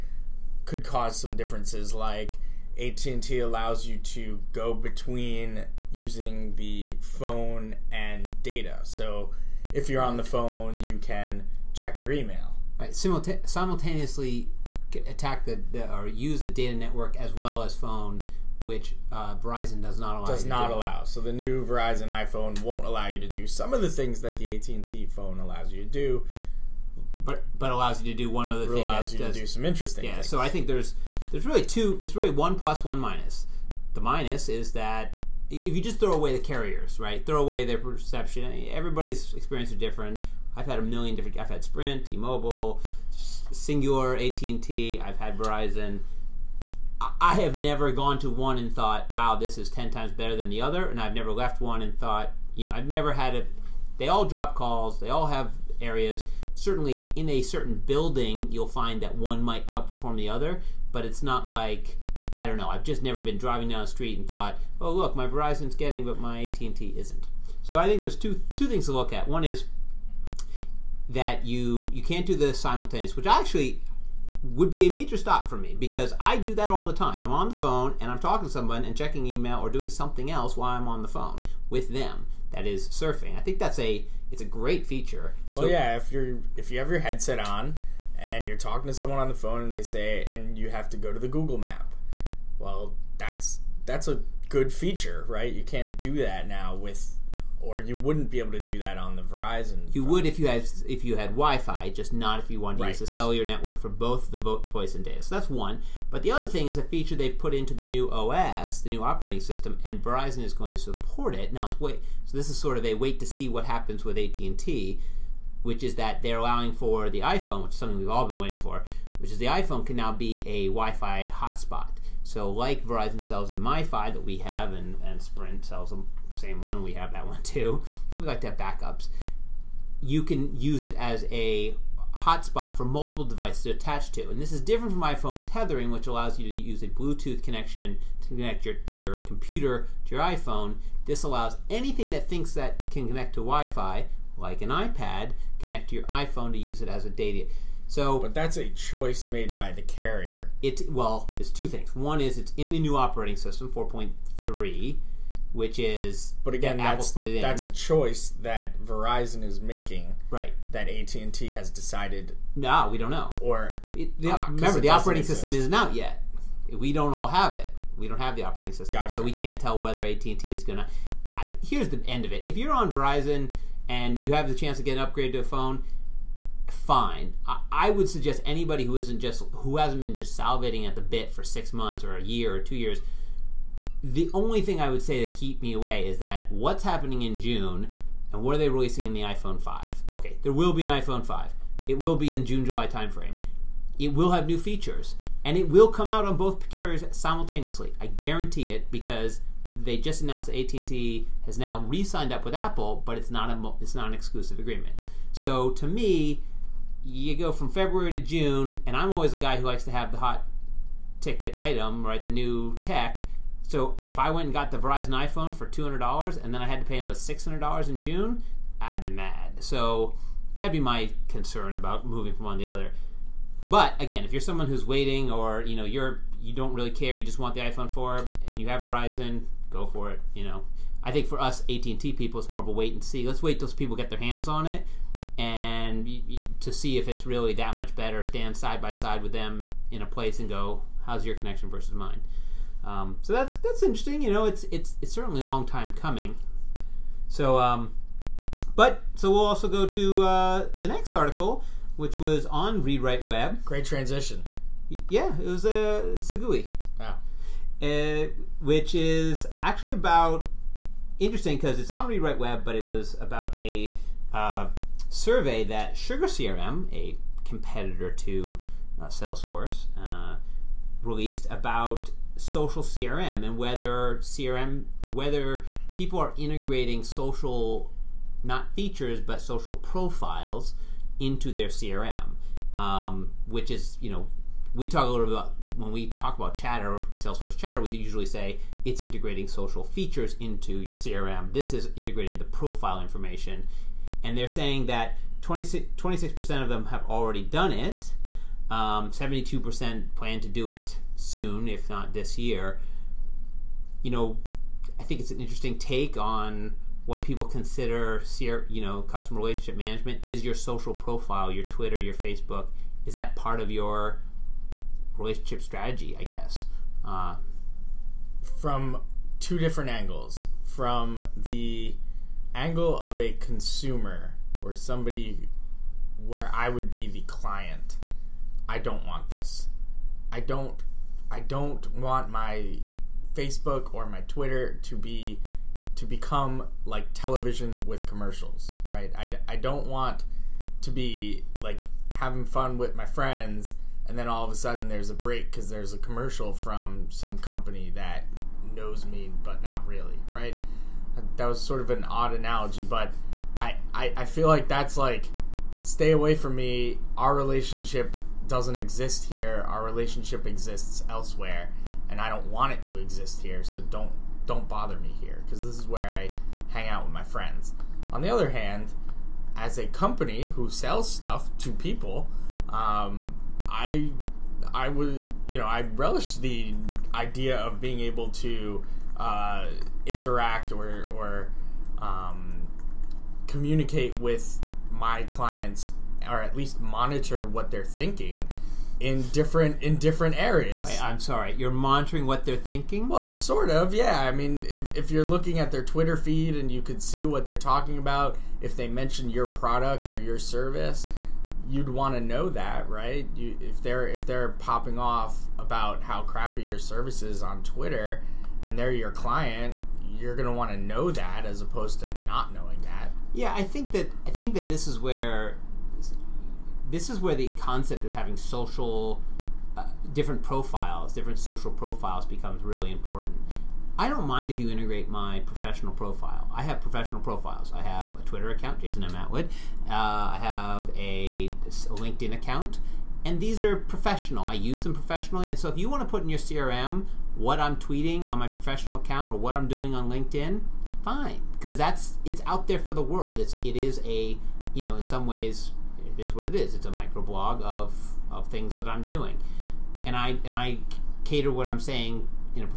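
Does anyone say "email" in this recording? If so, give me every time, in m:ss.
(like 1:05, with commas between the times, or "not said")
0:12, 1:19.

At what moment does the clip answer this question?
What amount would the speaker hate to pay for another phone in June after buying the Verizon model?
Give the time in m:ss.
3:37.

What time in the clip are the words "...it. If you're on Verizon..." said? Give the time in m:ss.
2:52.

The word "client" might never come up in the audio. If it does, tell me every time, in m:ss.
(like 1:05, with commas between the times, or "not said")
5:27, 6:25, 6:49.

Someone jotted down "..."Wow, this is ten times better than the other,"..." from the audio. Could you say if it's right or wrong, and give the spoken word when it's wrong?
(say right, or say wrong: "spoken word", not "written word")
right.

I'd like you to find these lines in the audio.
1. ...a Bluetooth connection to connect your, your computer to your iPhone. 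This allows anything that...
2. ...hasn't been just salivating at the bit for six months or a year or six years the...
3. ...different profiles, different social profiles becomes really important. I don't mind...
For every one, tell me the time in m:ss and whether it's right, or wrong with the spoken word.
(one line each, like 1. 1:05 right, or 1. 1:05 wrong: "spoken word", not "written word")
1. 2:16 right
2. 2:59 wrong: "two", not "six"
3. 7:00 right.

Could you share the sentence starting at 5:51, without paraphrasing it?
That was sort of an odd analogy, but I, I, I feel like that's like stay away from me.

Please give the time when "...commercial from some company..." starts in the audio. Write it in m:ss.
5:45.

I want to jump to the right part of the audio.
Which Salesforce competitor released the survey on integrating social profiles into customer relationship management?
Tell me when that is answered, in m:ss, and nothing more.
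4:25.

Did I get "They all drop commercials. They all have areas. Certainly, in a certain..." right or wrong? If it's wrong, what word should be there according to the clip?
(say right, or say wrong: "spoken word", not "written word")
wrong: "calls", not "commercials".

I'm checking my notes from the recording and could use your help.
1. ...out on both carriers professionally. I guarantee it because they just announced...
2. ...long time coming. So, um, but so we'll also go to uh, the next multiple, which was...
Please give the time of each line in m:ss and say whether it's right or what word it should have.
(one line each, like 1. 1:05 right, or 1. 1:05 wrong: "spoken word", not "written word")
1. 3:16 wrong: "simultaneously", not "professionally"
2. 4:05 wrong: "article", not "multiple".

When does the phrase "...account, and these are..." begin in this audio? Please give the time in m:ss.
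7:12.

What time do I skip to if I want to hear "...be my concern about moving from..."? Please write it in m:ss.
3:40.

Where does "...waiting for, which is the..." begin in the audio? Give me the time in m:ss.
1:58.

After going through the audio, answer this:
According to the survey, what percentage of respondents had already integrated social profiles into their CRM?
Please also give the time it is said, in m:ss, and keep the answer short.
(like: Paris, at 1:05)
26%, at 4:55.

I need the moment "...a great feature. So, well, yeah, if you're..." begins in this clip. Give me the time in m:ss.
1:24.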